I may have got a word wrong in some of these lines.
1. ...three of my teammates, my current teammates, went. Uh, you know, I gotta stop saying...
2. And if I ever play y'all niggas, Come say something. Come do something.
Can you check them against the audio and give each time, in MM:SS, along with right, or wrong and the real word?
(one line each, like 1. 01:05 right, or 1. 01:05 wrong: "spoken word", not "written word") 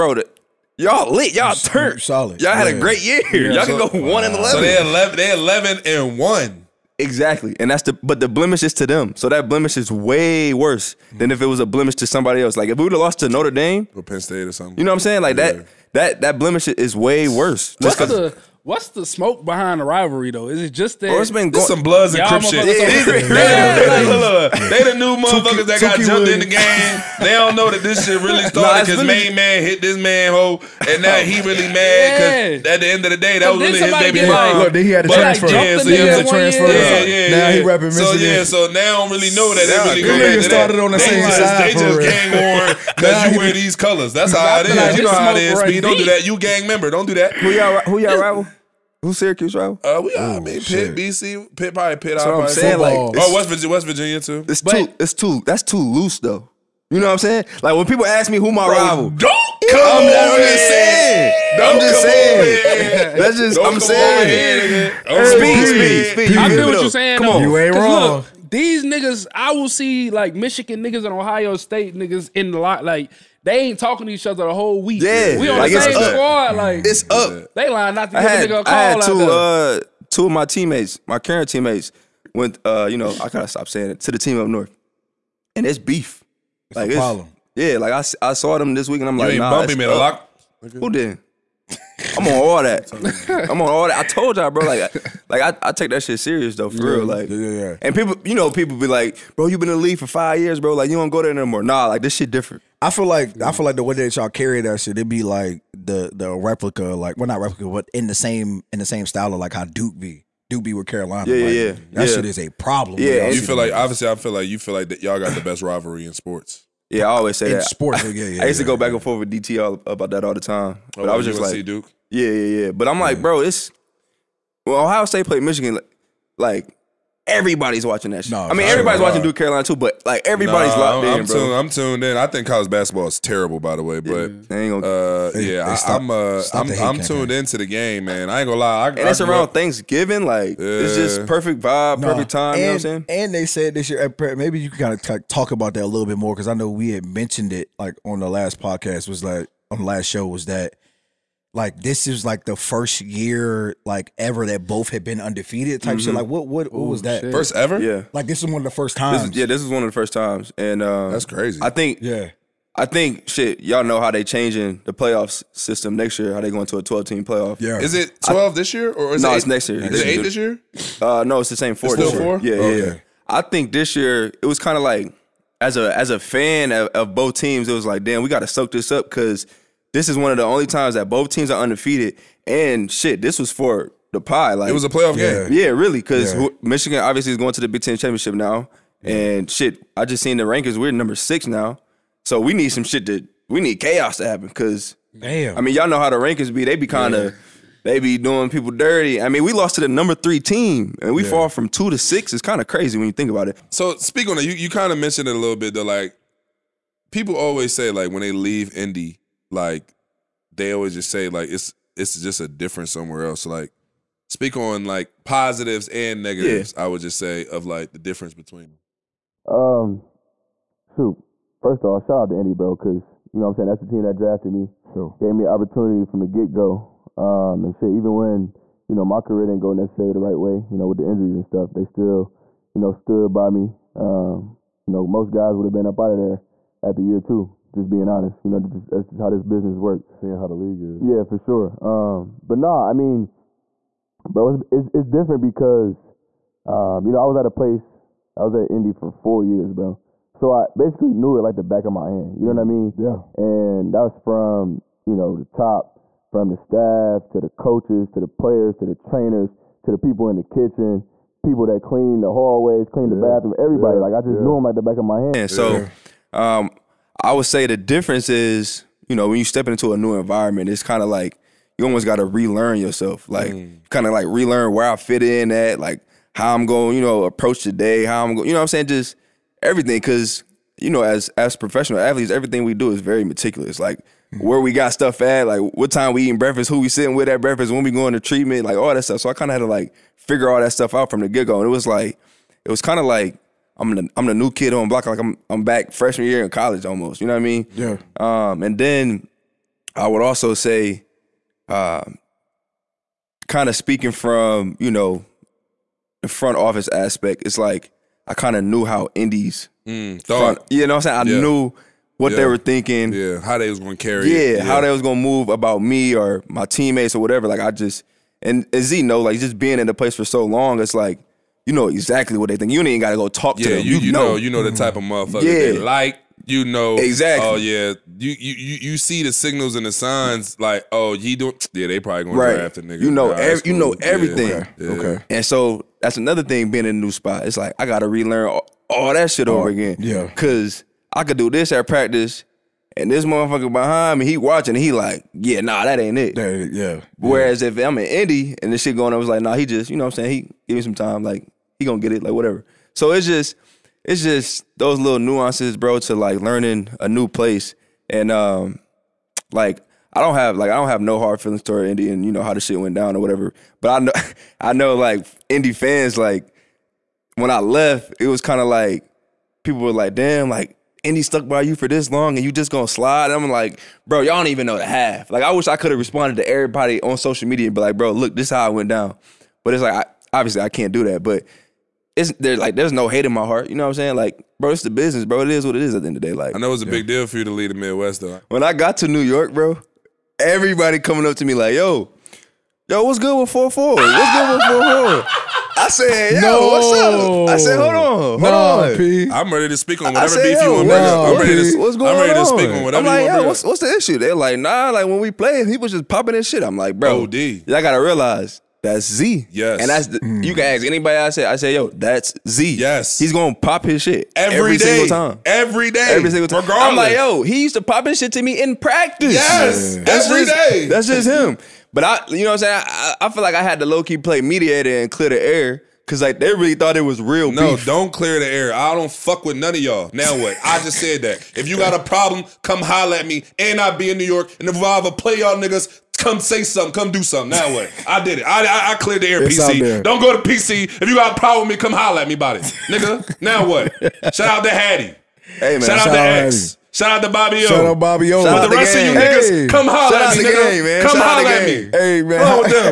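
1. 01:20 wrong: "two", not "three"
2. 07:14 right.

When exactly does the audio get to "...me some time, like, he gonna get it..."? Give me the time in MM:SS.
05:50.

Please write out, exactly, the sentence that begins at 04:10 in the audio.
So I basically knew it like the back of my hand.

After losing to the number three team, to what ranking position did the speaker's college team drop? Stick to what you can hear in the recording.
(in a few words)
6.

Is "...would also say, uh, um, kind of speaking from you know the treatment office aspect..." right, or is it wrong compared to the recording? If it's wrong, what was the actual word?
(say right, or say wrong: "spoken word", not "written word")
wrong: "front", not "treatment".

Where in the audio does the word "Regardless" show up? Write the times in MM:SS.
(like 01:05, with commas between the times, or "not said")
06:56.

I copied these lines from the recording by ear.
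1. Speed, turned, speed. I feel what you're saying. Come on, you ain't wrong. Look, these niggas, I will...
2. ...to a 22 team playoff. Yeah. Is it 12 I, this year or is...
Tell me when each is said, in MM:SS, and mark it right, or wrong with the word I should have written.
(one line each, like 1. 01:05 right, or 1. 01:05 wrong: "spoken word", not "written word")
1. 01:05 wrong: "speed", not "turned"
2. 02:46 wrong: "12", not "22".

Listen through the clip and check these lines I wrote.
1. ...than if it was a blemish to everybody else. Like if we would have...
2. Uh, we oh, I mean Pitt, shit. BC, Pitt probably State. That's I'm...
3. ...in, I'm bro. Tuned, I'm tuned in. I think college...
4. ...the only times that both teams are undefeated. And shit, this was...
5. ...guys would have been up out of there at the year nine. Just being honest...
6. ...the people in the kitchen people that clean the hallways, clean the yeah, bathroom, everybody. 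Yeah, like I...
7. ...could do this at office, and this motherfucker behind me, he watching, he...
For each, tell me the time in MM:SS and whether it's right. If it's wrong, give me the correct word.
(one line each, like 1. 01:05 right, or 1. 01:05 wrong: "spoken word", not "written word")
1. 00:11 wrong: "somebody", not "everybody"
2. 00:49 wrong: "Pitt", not "State"
3. 02:11 right
4. 03:00 right
5. 03:55 wrong: "two", not "nine"
6. 04:19 right
7. 05:41 wrong: "practice", not "office".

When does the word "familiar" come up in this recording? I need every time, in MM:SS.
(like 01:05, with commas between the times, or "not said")
not said.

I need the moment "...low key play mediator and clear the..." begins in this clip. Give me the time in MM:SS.
07:03.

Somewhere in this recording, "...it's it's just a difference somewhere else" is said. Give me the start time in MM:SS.
03:31.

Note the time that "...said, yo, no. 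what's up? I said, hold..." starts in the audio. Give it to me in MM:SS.
06:35.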